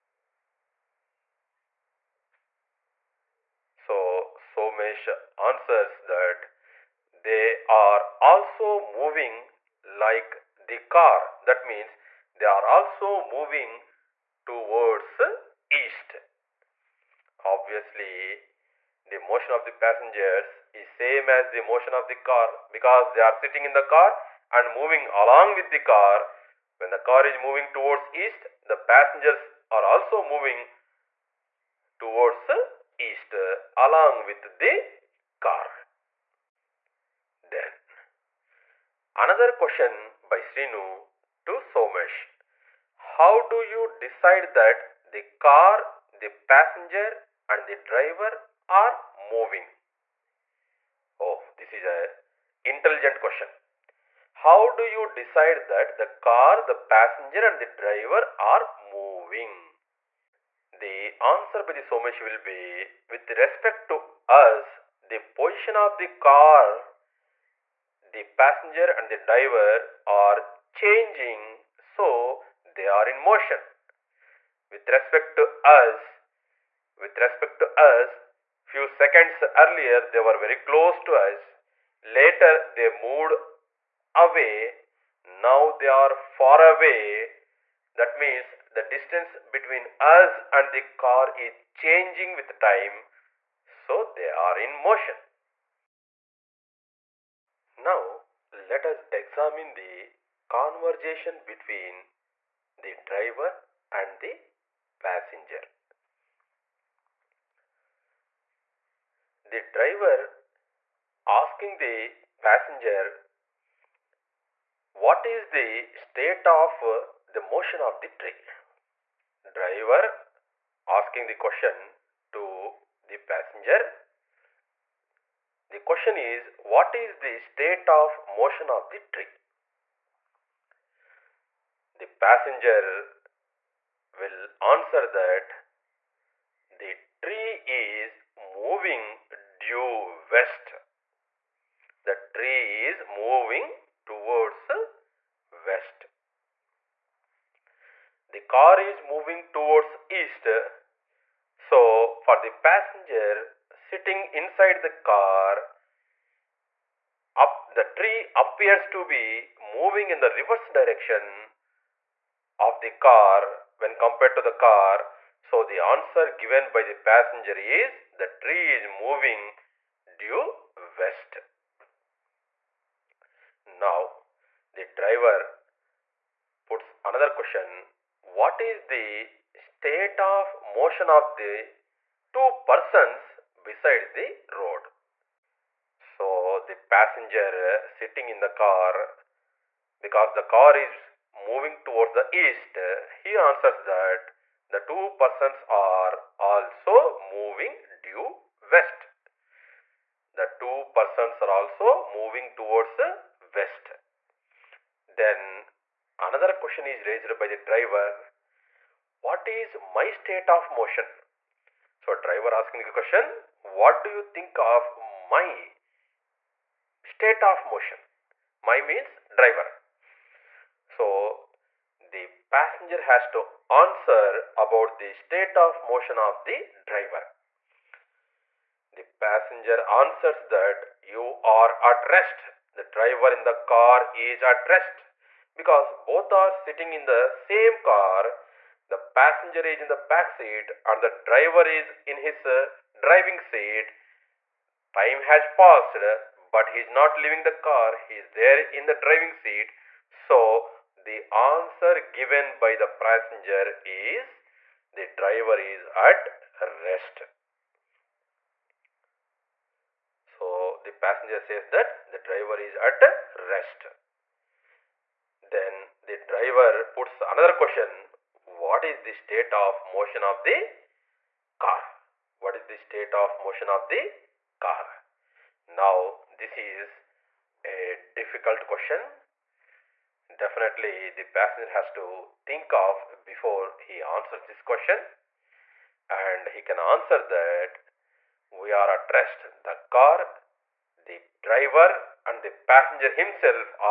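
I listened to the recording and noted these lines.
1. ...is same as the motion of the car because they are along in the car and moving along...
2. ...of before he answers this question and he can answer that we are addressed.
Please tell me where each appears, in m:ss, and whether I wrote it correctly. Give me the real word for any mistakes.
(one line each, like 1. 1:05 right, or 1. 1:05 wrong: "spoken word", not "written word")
1. 0:20 wrong: "sitting", not "along"
2. 4:42 right.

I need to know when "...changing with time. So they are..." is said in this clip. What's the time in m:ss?
1:31.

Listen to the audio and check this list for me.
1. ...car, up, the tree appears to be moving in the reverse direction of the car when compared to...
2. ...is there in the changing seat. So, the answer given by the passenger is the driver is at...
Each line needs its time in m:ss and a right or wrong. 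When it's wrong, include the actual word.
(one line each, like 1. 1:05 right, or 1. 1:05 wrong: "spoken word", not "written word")
1. 2:35 right
2. 4:08 wrong: "driving", not "changing".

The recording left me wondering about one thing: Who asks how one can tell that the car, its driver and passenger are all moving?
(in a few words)
Srinu.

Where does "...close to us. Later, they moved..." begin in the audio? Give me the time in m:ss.
1:20.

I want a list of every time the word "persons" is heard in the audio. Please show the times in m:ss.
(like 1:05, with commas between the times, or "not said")
3:02, 3:15, 3:20.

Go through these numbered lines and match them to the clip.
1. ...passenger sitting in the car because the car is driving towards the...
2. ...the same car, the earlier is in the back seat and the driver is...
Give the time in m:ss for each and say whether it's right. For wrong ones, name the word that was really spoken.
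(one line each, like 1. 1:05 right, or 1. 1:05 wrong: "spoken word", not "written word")
1. 3:06 wrong: "moving", not "driving"
2. 3:57 wrong: "passenger", not "earlier".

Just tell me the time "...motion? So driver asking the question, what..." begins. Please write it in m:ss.
3:30.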